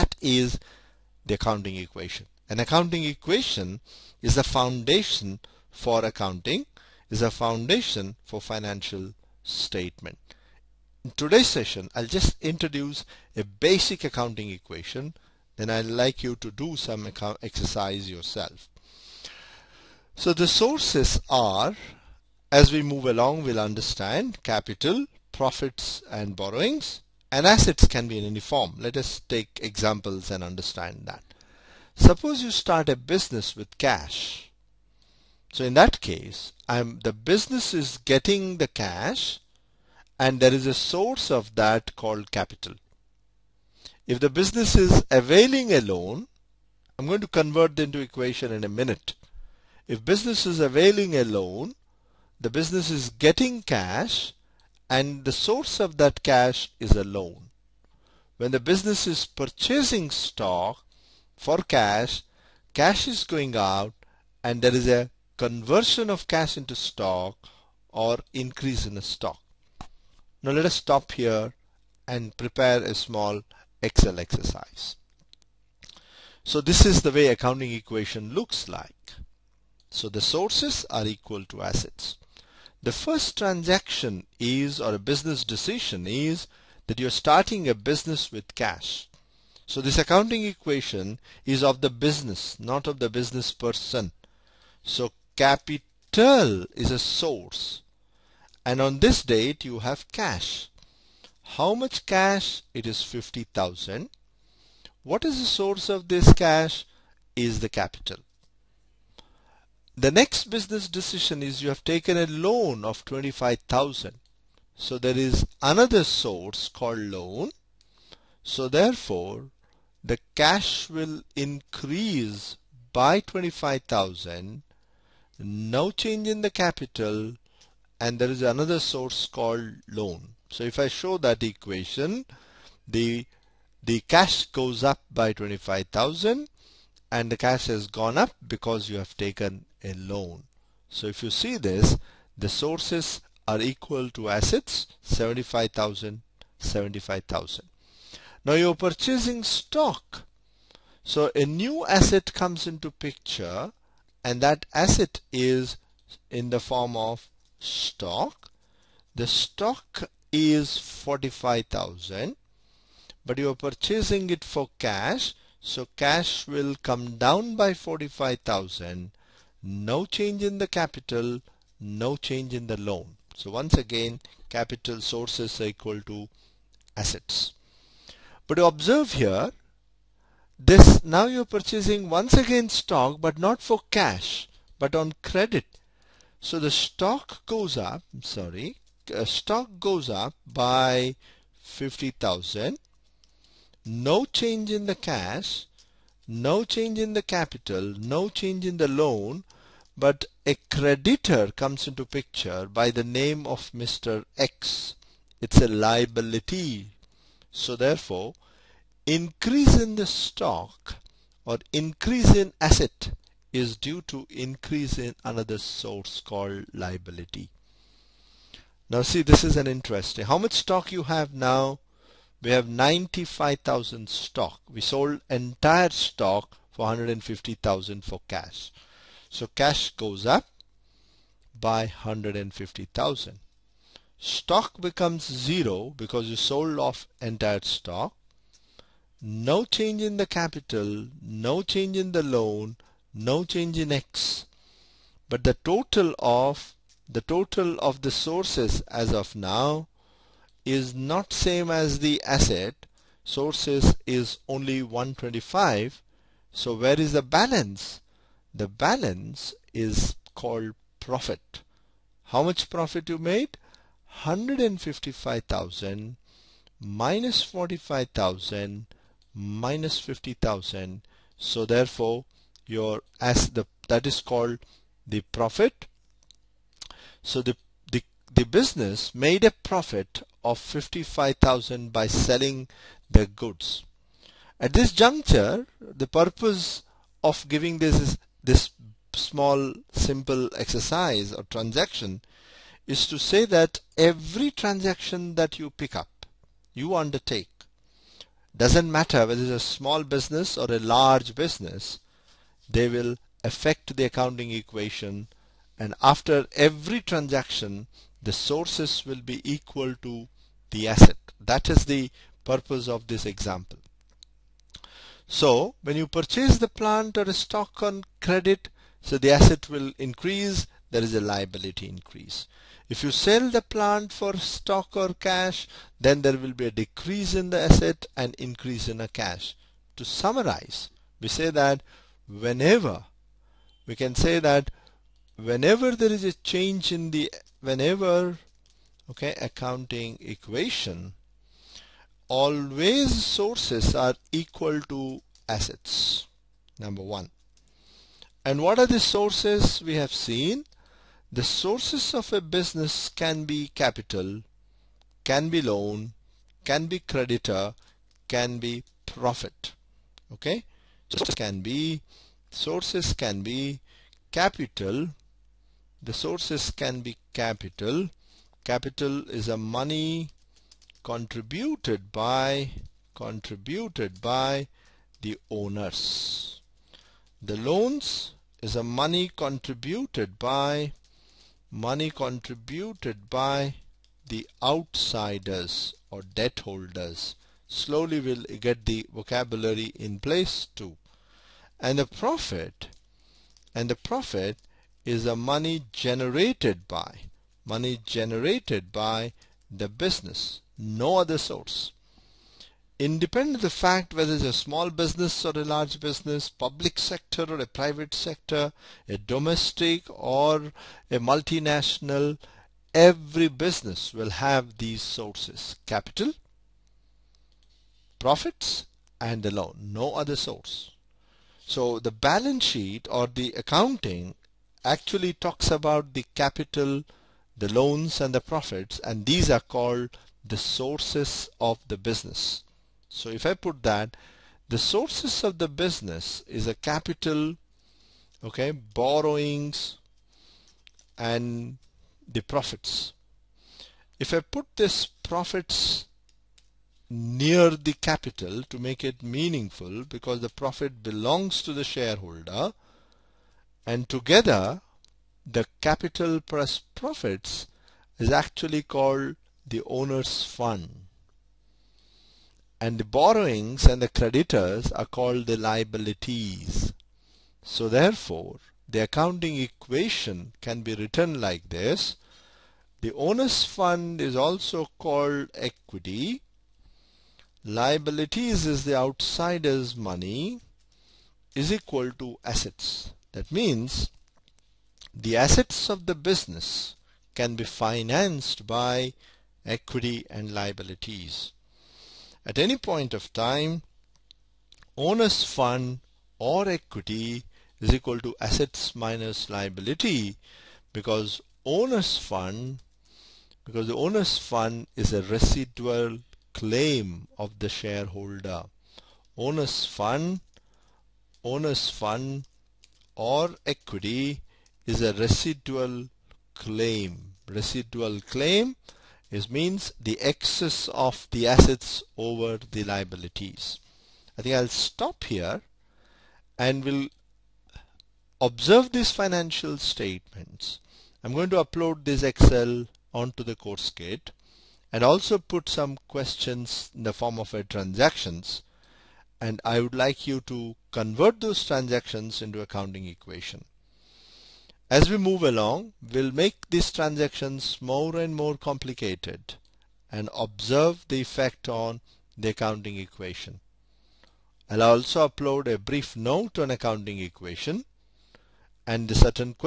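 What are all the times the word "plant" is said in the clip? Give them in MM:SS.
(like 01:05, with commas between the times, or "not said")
05:16, 05:23.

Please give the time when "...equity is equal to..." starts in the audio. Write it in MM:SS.
08:16.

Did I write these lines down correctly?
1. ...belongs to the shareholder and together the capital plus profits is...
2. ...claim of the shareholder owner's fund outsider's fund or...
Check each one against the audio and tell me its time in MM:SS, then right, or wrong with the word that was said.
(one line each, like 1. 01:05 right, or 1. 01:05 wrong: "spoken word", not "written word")
1. 07:31 right
2. 08:26 wrong: "owner", not "outsider".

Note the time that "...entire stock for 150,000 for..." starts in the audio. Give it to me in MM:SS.
03:45.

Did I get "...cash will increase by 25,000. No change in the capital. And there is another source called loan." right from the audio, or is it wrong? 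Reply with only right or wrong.
right.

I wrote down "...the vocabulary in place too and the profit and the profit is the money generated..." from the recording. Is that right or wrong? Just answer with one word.
right.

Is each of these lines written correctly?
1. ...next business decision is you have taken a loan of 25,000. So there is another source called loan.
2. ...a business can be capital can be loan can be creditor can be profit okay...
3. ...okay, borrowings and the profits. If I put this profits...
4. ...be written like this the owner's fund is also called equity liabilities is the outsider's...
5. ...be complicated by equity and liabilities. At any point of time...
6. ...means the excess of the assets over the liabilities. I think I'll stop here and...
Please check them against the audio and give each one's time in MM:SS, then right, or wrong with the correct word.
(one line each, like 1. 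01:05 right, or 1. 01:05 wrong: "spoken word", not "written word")
1. 01:50 right
2. 05:52 right
3. 07:18 right
4. 07:50 right
5. 08:07 wrong: "financed", not "complicated"
6. 08:39 right.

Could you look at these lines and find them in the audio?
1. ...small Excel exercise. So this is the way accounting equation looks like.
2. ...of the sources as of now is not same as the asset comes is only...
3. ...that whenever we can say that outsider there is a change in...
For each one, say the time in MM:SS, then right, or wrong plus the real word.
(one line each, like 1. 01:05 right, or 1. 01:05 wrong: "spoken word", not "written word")
1. 01:12 right
2. 04:07 wrong: "sources", not "comes"
3. 05:31 wrong: "whenever", not "outsider".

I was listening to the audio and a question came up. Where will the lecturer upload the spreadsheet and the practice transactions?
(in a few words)
course kit.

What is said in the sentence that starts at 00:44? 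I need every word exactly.
If the business is availing a loan, I'm going to convert into equation in a minute.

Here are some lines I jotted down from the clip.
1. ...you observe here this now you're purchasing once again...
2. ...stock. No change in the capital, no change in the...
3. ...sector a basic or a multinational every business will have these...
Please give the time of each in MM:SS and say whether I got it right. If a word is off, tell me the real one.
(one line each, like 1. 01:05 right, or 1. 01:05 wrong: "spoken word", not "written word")
1. 02:58 right
2. 03:57 right
3. 06:48 wrong: "domestic", not "basic".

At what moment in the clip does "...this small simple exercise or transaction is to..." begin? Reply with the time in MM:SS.
04:48.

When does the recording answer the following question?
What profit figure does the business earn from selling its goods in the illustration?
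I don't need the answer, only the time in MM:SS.
04:40.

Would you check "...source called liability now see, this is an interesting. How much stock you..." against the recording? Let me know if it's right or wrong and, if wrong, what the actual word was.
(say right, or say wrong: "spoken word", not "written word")
right.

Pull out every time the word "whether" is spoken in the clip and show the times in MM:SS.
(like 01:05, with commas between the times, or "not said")
04:59, 06:44.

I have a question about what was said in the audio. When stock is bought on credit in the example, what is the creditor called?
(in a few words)
Mr X.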